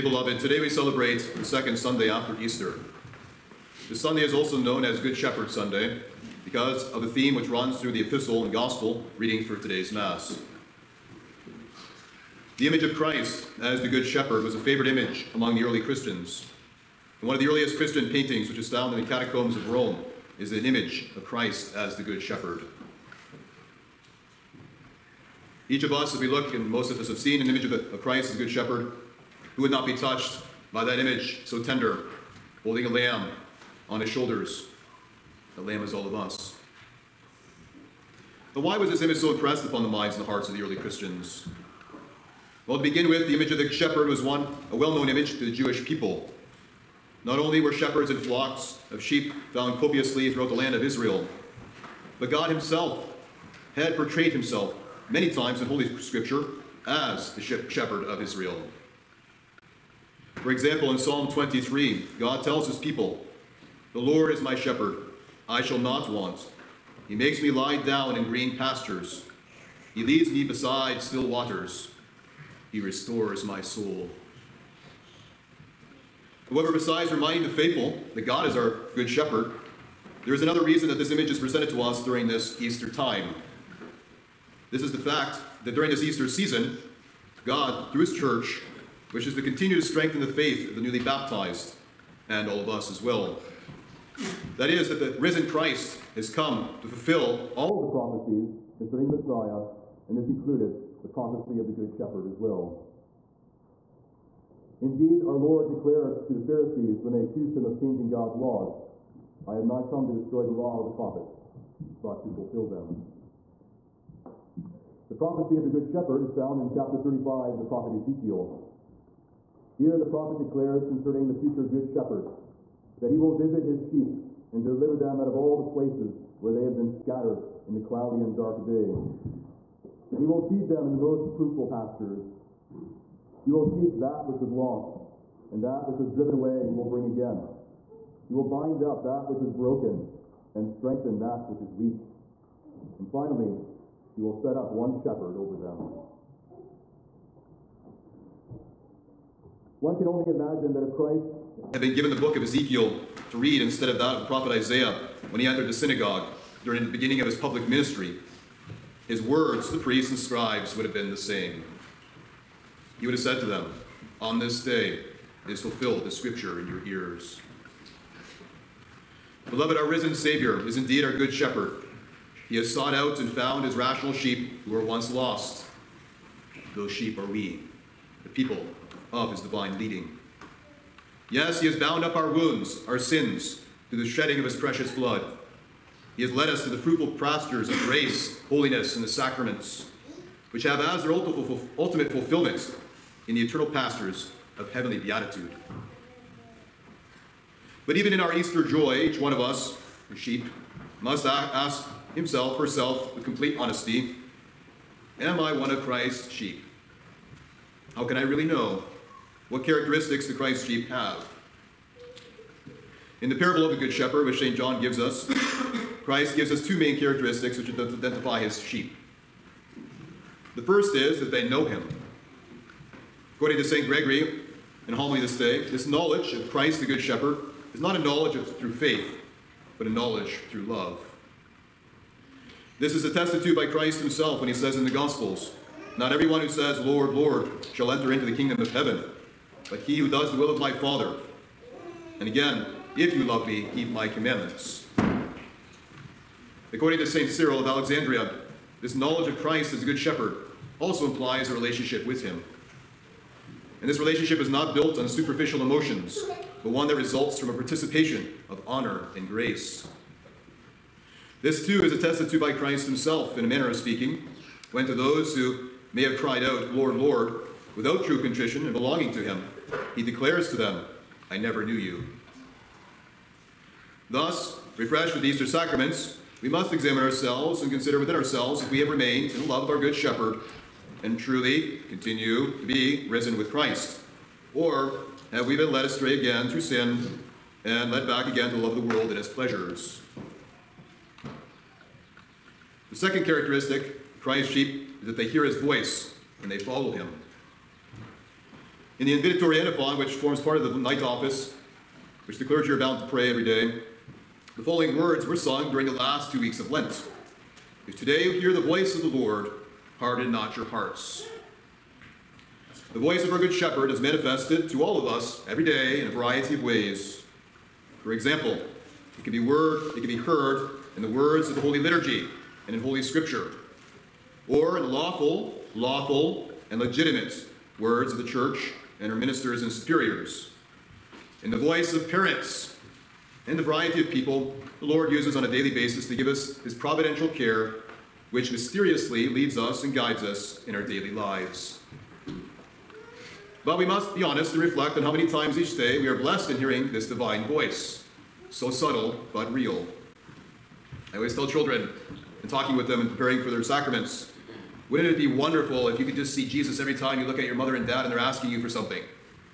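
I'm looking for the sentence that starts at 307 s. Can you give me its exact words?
If today you hear the voice of the Lord, harden not your hearts.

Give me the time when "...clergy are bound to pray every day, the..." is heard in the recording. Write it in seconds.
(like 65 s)
302 s.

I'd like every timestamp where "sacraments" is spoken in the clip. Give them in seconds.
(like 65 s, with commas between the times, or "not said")
189 s, 275 s, 353 s.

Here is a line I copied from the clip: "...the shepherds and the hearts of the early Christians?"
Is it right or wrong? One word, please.
wrong.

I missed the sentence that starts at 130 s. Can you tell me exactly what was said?
And he will feed them in the most fruitful pastures.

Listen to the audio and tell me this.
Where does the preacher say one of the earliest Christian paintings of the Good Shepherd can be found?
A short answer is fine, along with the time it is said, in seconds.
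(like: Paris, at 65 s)
Catacombs of Rome, at 19 s.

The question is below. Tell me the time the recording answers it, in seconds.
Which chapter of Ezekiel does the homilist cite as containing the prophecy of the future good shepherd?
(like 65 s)
116 s.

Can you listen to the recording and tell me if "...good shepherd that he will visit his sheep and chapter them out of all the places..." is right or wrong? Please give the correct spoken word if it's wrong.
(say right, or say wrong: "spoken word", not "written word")
wrong: "deliver", not "chapter".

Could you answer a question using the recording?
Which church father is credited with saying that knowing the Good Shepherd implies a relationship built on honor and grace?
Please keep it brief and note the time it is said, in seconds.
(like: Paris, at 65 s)
St. Cyril of Alexandria, at 247 s.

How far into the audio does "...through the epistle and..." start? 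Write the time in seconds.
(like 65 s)
7 s.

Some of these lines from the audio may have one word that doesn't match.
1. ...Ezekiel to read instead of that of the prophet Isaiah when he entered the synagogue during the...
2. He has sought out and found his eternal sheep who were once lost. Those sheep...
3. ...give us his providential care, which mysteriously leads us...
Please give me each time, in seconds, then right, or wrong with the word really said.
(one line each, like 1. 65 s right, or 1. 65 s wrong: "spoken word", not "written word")
1. 152 s right
2. 172 s wrong: "rational", not "eternal"
3. 336 s right.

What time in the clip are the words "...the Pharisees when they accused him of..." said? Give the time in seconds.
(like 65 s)
106 s.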